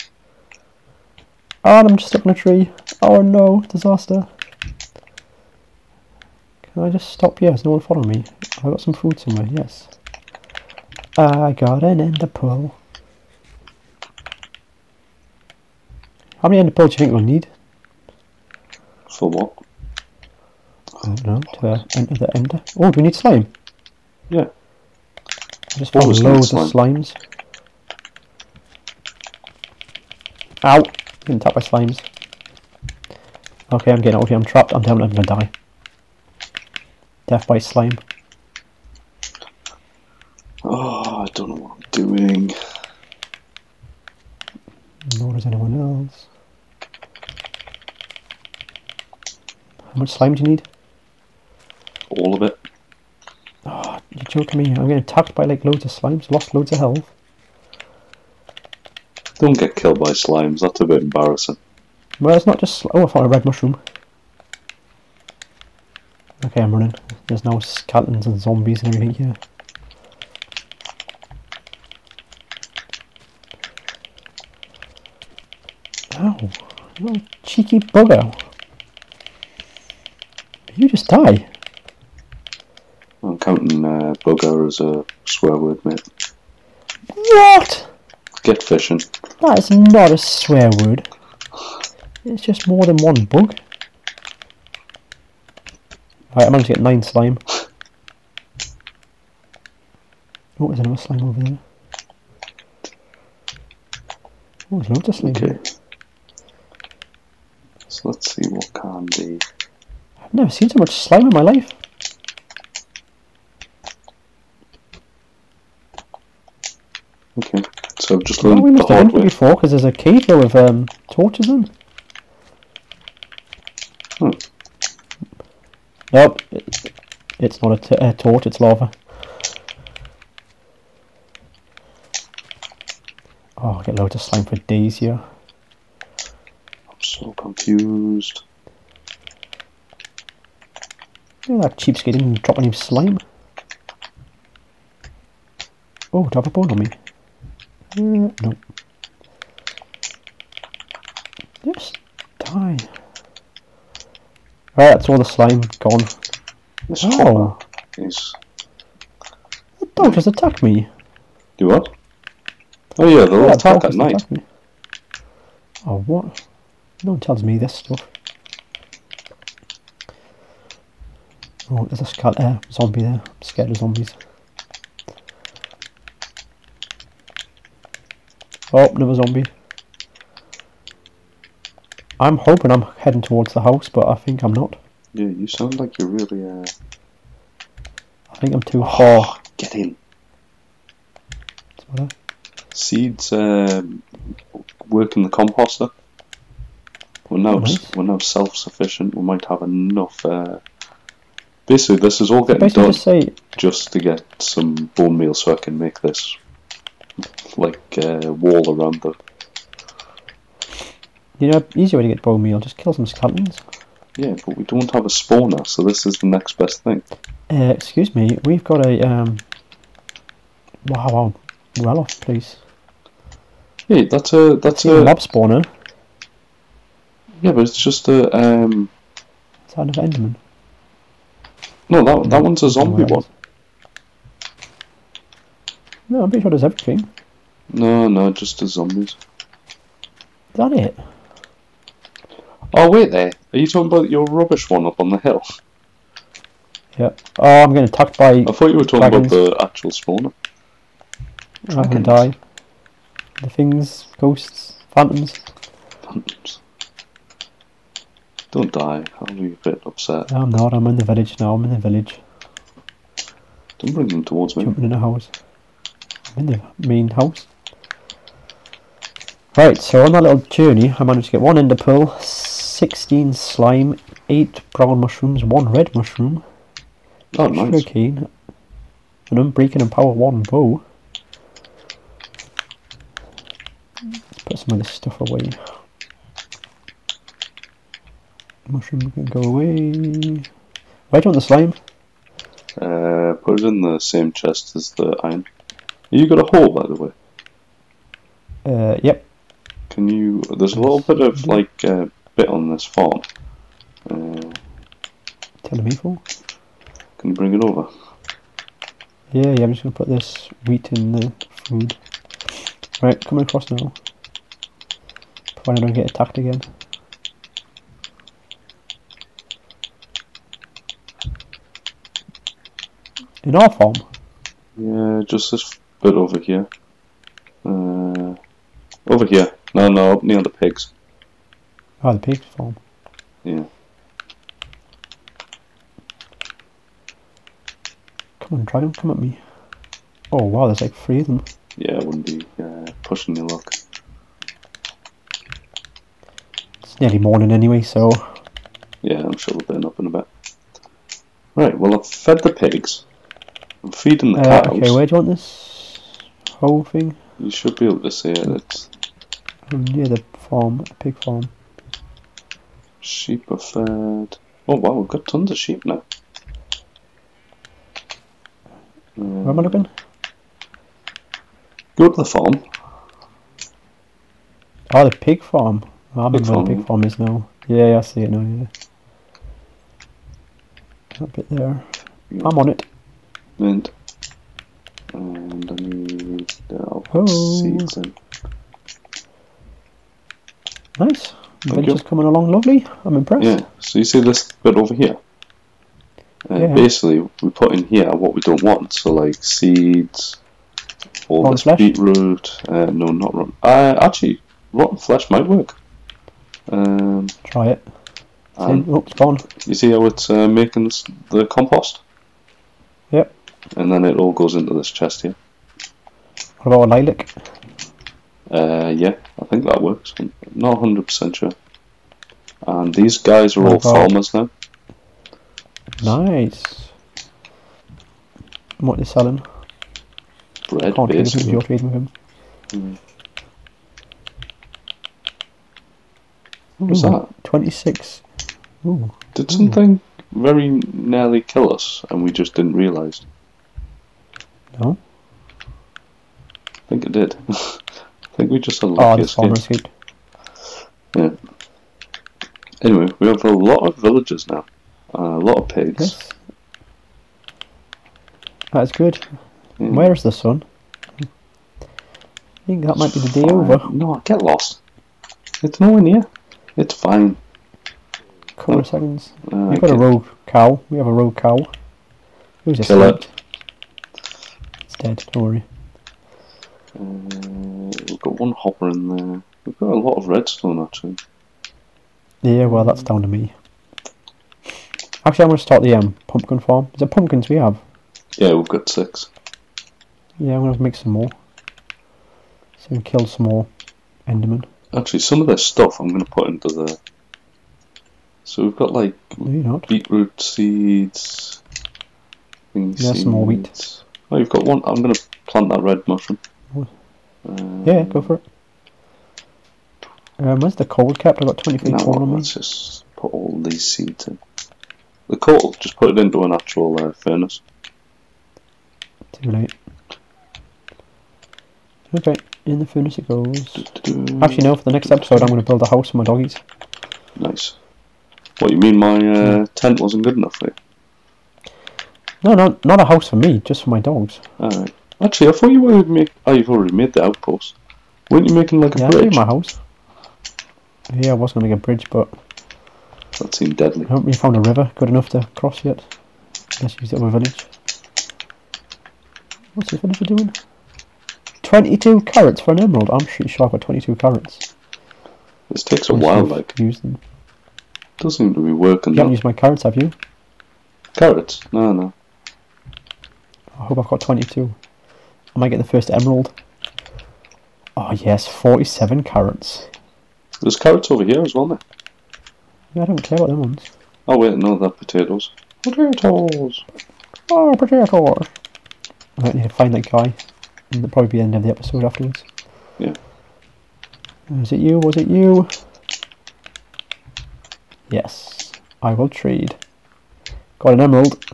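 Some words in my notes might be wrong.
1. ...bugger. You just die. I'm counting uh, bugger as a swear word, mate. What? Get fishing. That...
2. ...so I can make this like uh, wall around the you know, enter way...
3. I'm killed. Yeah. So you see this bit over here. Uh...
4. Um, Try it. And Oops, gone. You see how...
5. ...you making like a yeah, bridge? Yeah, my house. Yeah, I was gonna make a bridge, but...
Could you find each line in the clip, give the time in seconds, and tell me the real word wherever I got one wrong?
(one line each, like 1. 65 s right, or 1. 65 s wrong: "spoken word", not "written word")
1. 77 s right
2. 205 s wrong: "easier", not "enter"
3. 393 s wrong: "impressed", not "killed"
4. 406 s right
5. 538 s right.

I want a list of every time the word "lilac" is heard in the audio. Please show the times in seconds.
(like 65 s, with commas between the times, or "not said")
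416 s.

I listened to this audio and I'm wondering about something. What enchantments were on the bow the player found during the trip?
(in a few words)
Unbreaking and Power 1.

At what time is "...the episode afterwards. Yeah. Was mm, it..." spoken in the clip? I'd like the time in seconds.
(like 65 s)
581 s.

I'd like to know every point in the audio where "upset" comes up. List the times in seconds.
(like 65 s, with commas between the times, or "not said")
259 s.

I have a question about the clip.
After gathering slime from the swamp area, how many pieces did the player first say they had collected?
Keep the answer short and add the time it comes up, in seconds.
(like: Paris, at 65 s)
9, at 96 s.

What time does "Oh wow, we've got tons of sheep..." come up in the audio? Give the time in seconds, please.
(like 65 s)
364 s.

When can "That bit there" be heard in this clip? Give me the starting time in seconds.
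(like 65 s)
381 s.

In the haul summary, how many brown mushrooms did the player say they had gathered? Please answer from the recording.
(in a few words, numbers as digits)
8.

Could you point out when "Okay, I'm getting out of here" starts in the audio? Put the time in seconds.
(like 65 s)
33 s.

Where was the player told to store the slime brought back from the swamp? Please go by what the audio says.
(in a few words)
Same chest as the iron.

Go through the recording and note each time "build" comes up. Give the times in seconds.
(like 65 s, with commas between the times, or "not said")
525 s.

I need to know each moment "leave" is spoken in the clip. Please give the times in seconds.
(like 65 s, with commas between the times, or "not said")
not said.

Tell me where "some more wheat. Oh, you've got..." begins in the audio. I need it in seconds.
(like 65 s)
503 s.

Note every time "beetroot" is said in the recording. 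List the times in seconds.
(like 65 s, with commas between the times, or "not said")
401 s, 499 s.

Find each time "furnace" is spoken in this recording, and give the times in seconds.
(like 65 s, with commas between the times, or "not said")
517 s, 522 s.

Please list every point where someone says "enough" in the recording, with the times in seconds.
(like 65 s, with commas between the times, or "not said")
199 s, 530 s, 545 s.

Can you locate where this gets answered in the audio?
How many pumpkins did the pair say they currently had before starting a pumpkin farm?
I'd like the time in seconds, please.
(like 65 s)
488 s.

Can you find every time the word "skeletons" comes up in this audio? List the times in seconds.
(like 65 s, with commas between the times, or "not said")
67 s, 213 s.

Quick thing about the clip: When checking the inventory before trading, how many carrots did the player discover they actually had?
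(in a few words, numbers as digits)
47.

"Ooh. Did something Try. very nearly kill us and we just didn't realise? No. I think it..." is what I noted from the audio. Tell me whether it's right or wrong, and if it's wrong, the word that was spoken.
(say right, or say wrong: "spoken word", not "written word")
wrong: "Ooh", not "Try".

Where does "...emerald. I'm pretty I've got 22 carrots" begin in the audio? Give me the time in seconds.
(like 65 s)
552 s.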